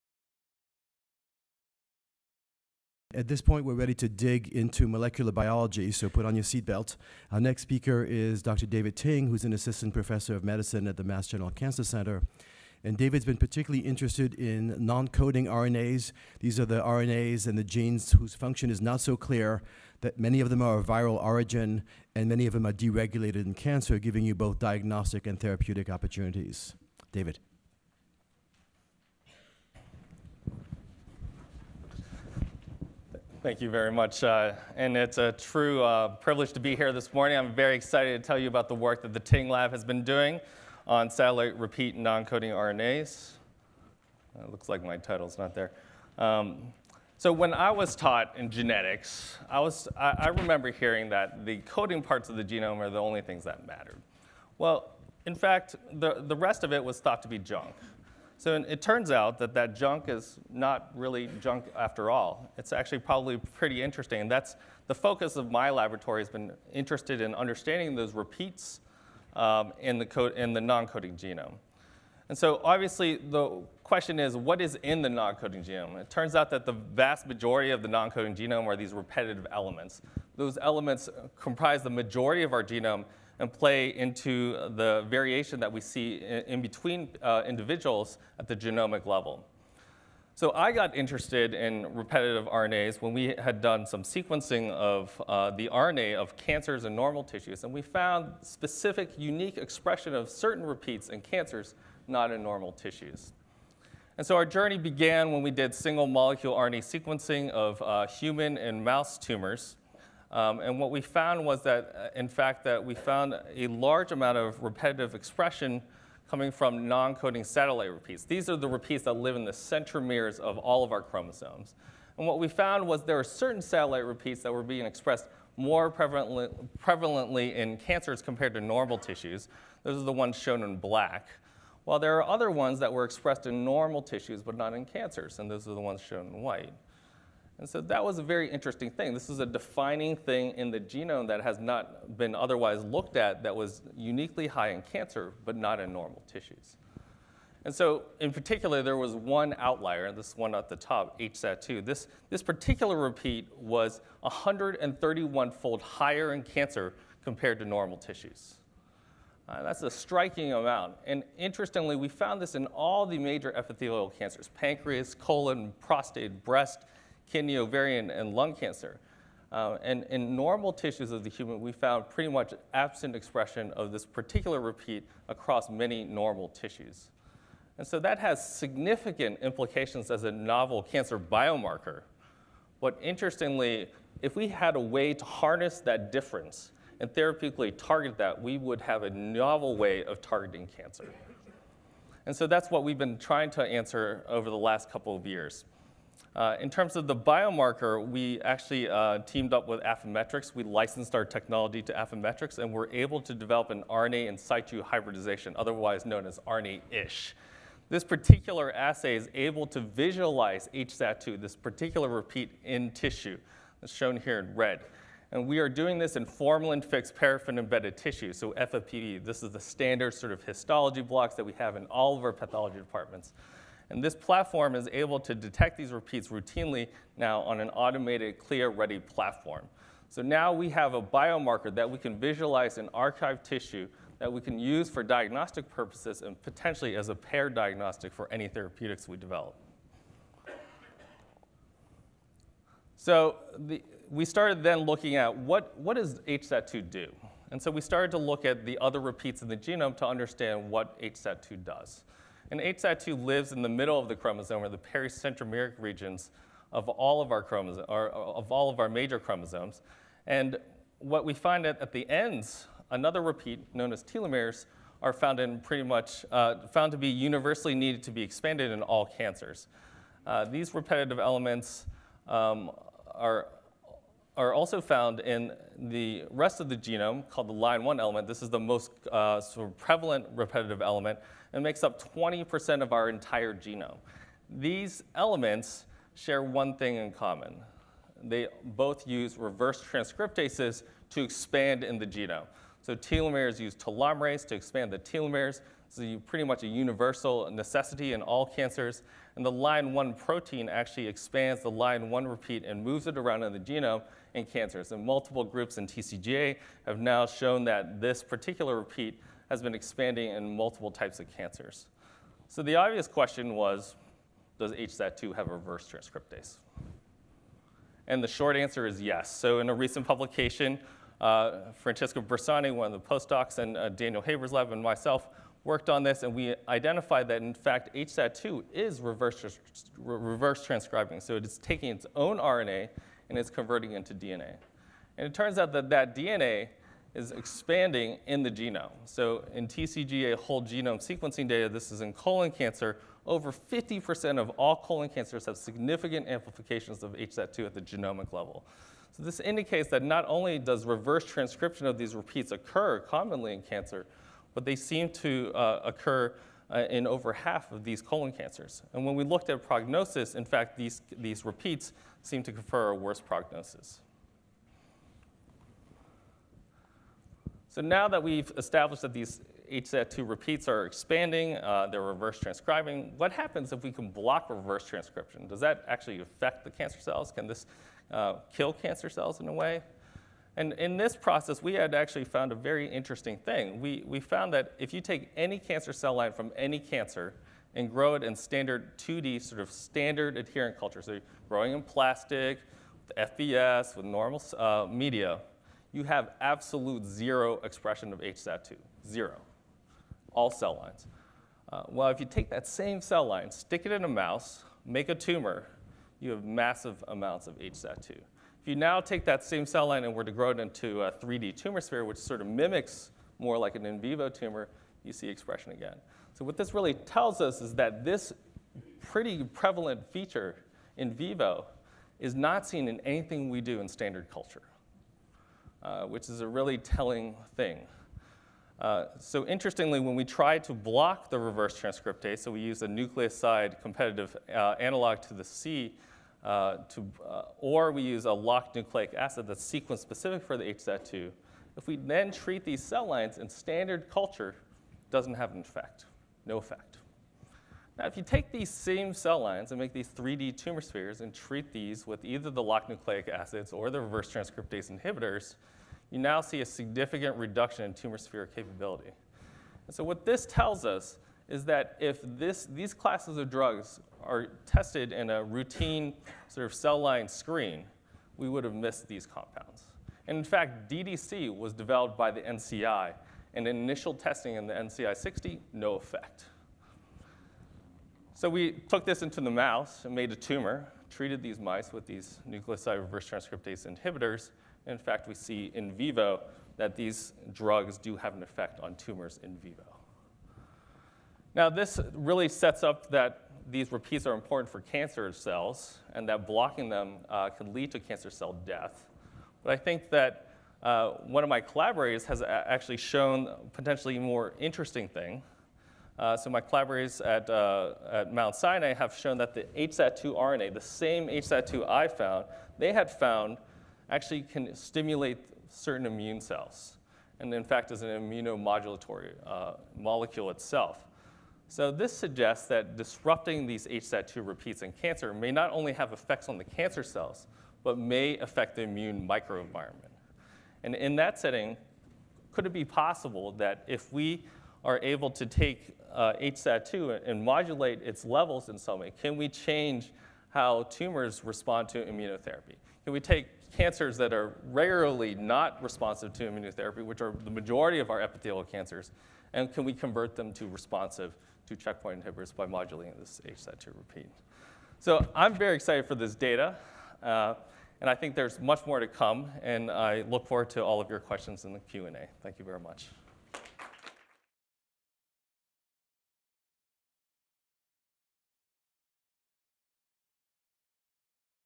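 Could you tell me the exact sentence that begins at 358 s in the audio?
And when we looked at prognosis, in fact, these, these repeats seem to confer a worse prognosis.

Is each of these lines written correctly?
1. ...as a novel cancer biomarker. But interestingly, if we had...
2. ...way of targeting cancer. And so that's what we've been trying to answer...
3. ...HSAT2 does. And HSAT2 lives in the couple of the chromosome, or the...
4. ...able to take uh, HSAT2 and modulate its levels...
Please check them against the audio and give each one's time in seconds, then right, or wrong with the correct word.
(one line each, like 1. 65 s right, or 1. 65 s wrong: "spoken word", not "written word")
1. 180 s right
2. 189 s right
3. 251 s wrong: "middle", not "couple"
4. 535 s right.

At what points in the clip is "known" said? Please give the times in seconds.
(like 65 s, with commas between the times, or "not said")
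206 s, 263 s.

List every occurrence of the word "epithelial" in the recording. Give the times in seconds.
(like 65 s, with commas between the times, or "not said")
163 s, 548 s.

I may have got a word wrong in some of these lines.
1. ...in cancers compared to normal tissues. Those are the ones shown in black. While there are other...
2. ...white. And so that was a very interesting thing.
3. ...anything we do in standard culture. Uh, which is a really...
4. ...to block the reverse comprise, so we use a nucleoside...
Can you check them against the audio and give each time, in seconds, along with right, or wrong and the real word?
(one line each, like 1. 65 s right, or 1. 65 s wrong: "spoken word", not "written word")
1. 127 s right
2. 136 s right
3. 423 s right
4. 430 s wrong: "transcriptase", not "comprise".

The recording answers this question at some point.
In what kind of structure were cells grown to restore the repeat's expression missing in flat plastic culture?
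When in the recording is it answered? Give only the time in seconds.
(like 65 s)
411 s.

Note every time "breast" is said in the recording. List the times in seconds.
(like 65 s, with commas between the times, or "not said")
166 s.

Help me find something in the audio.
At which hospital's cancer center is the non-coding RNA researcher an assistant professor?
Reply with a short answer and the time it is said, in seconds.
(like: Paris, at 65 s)
Mass General, at 11 s.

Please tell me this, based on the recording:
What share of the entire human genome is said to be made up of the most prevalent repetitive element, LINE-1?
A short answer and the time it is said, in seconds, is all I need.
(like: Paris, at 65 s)
20%, at 282 s.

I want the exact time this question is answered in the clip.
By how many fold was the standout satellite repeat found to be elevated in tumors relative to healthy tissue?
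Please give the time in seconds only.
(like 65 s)
154 s.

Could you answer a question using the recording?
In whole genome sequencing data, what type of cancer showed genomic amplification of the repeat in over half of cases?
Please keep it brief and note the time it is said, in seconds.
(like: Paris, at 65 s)
colon cancer, at 342 s.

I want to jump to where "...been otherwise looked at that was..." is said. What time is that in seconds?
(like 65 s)
142 s.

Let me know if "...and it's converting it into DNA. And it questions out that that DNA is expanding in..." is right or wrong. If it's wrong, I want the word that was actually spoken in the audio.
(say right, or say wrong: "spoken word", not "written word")
wrong: "turns", not "questions".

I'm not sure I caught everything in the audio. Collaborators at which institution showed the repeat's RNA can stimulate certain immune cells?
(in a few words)
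Mount Sinai.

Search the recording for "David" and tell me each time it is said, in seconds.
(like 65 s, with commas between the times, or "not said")
8 s, 12 s, 27 s.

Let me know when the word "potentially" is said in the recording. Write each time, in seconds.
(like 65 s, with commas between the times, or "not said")
236 s, 503 s.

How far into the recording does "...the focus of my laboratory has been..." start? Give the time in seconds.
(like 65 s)
64 s.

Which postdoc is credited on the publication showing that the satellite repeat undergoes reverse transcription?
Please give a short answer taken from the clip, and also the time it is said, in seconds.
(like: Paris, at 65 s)
Francesco Bersani, at 321 s.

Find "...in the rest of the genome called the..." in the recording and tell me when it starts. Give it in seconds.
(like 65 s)
275 s.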